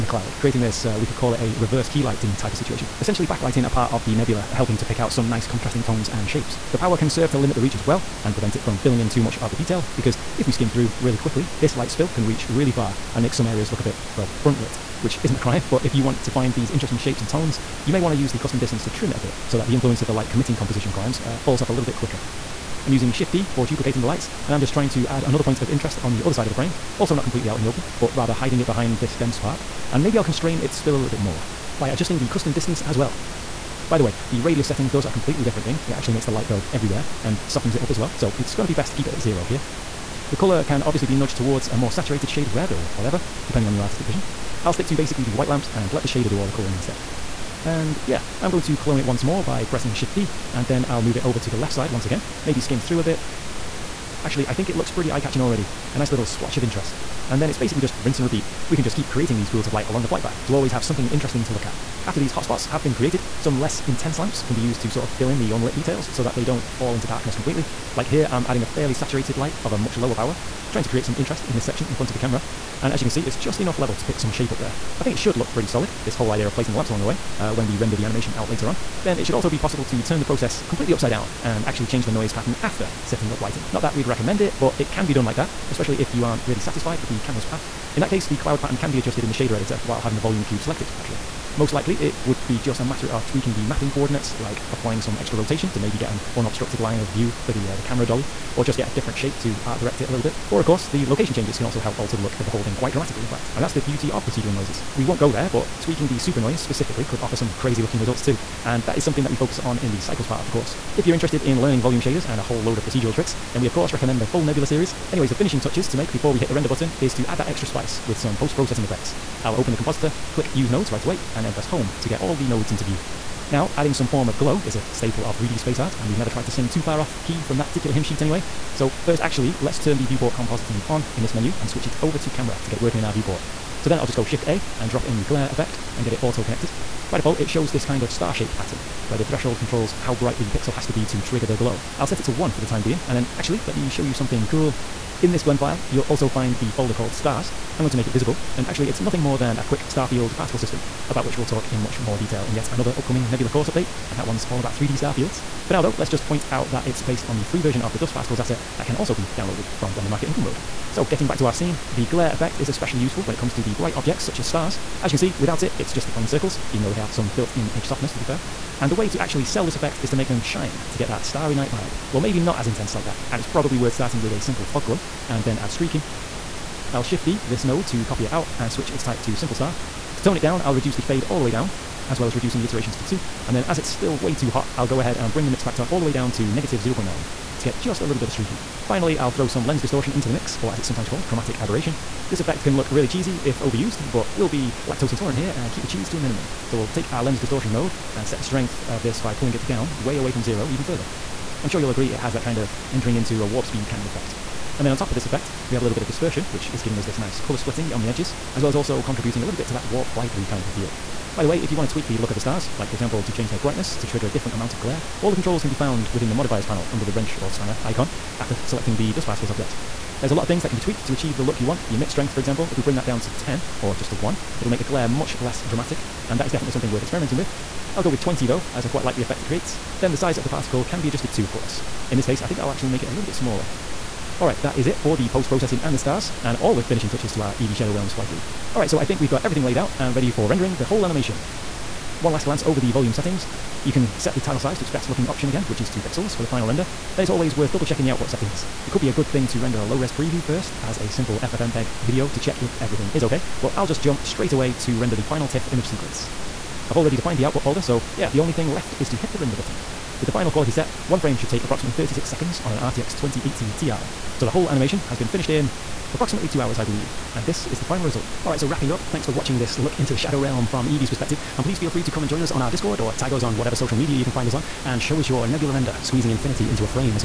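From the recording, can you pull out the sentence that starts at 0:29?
And maybe I'll constrain its spill a little bit more by adjusting the custom distance as well.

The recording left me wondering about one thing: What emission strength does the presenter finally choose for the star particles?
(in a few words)
20.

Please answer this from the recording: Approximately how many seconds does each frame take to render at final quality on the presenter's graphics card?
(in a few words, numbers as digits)
36.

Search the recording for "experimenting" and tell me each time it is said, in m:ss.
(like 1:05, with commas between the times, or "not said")
3:47.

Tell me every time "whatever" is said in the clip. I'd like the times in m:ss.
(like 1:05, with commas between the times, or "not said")
0:42, 4:33.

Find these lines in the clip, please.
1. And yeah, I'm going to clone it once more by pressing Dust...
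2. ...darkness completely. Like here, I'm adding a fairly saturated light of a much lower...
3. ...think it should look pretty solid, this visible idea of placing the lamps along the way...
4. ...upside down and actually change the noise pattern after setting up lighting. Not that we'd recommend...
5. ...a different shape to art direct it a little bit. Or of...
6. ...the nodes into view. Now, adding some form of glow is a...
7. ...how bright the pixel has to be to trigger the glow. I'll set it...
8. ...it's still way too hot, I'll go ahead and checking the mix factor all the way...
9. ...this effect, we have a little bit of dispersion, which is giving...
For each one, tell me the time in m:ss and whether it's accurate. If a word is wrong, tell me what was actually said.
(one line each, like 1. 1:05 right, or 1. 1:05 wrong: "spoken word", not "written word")
1. 0:47 wrong: "Shift", not "Dust"
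2. 1:07 right
3. 1:15 wrong: "whole", not "visible"
4. 1:20 right
5. 1:38 right
6. 2:02 right
7. 2:20 right
8. 3:03 wrong: "bring", not "checking"
9. 3:25 right.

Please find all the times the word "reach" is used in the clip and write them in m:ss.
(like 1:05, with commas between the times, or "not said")
0:07, 0:12.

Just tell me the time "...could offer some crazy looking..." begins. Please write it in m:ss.
1:47.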